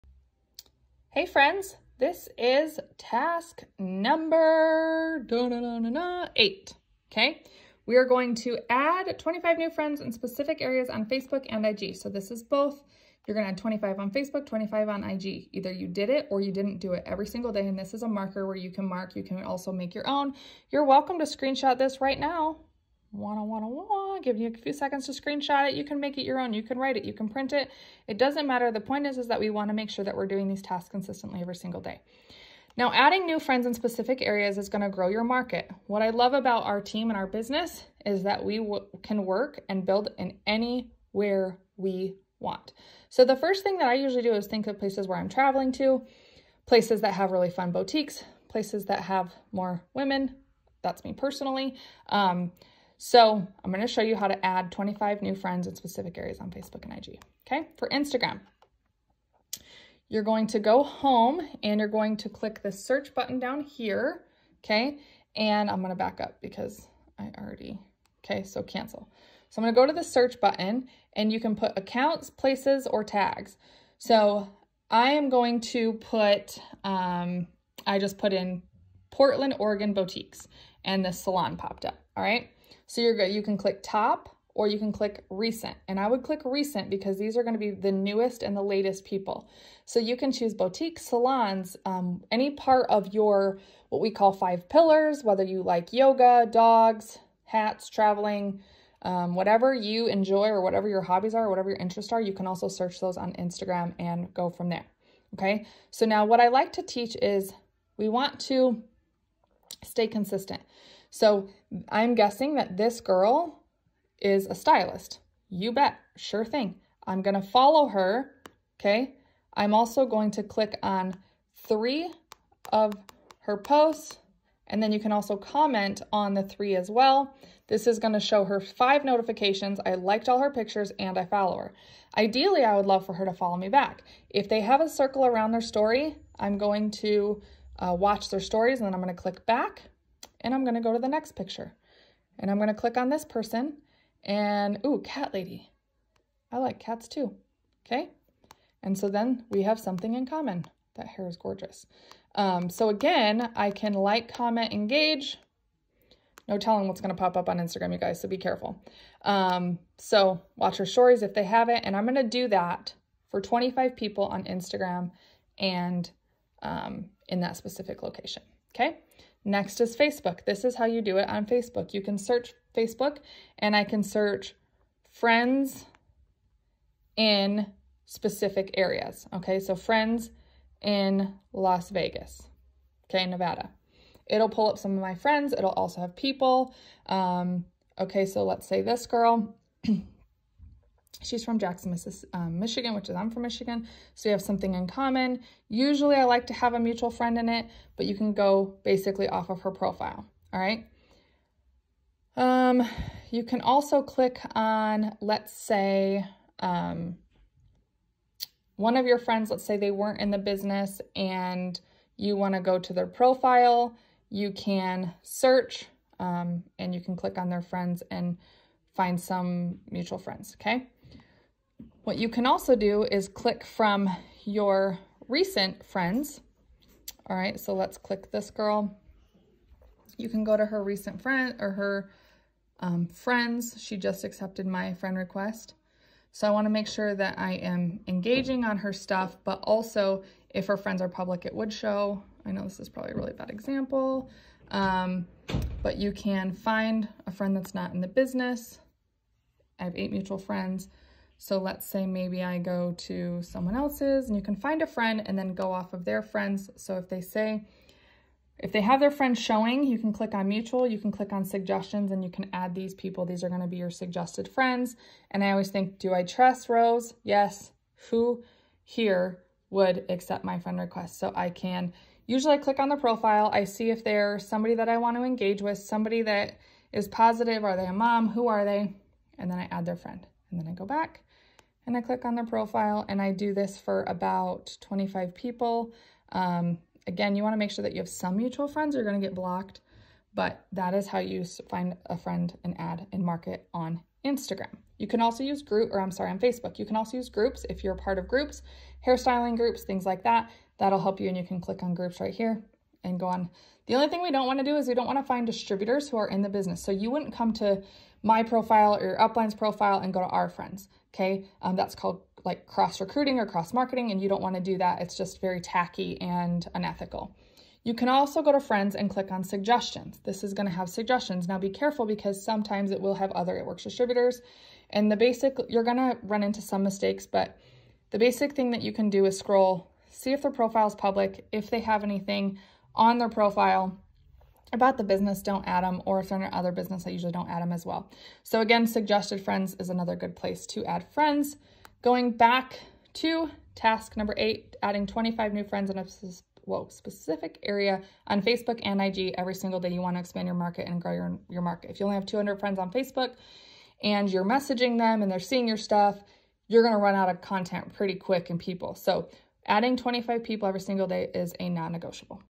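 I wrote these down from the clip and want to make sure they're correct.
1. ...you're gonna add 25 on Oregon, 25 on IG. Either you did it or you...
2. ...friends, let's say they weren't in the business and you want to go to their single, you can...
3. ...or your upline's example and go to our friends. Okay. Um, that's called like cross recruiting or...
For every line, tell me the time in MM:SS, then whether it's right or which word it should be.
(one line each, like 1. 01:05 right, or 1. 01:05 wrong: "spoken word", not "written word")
1. 00:13 wrong: "Facebook", not "Oregon"
2. 03:29 wrong: "profile", not "single"
3. 05:08 wrong: "profile", not "example".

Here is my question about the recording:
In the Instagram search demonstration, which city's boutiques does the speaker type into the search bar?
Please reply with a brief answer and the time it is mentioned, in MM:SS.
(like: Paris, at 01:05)
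Portland, Oregon, at 01:19.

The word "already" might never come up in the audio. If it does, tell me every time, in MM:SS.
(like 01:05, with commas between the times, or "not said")
01:07.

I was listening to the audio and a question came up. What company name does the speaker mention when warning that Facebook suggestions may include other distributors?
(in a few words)
It Works.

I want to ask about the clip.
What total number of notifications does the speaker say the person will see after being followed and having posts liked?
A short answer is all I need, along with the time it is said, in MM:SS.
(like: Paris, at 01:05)
5, at 02:08.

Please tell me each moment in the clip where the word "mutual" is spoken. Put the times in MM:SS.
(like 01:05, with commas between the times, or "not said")
03:16, 03:39, 04:10, 04:20, 04:48.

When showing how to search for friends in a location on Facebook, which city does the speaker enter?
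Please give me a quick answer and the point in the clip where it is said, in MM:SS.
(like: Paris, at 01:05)
Las Vegas, at 03:01.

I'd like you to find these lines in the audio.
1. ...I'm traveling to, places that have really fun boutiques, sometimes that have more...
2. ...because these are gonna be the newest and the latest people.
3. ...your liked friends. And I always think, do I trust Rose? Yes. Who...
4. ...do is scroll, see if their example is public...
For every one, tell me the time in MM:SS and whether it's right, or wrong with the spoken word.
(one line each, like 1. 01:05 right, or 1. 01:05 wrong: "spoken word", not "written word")
1. 00:45 wrong: "places", not "sometimes"
2. 01:26 right
3. 04:23 wrong: "suggested", not "liked"
4. 05:29 wrong: "profile", not "example".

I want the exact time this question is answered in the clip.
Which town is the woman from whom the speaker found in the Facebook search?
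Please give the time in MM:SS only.
03:11.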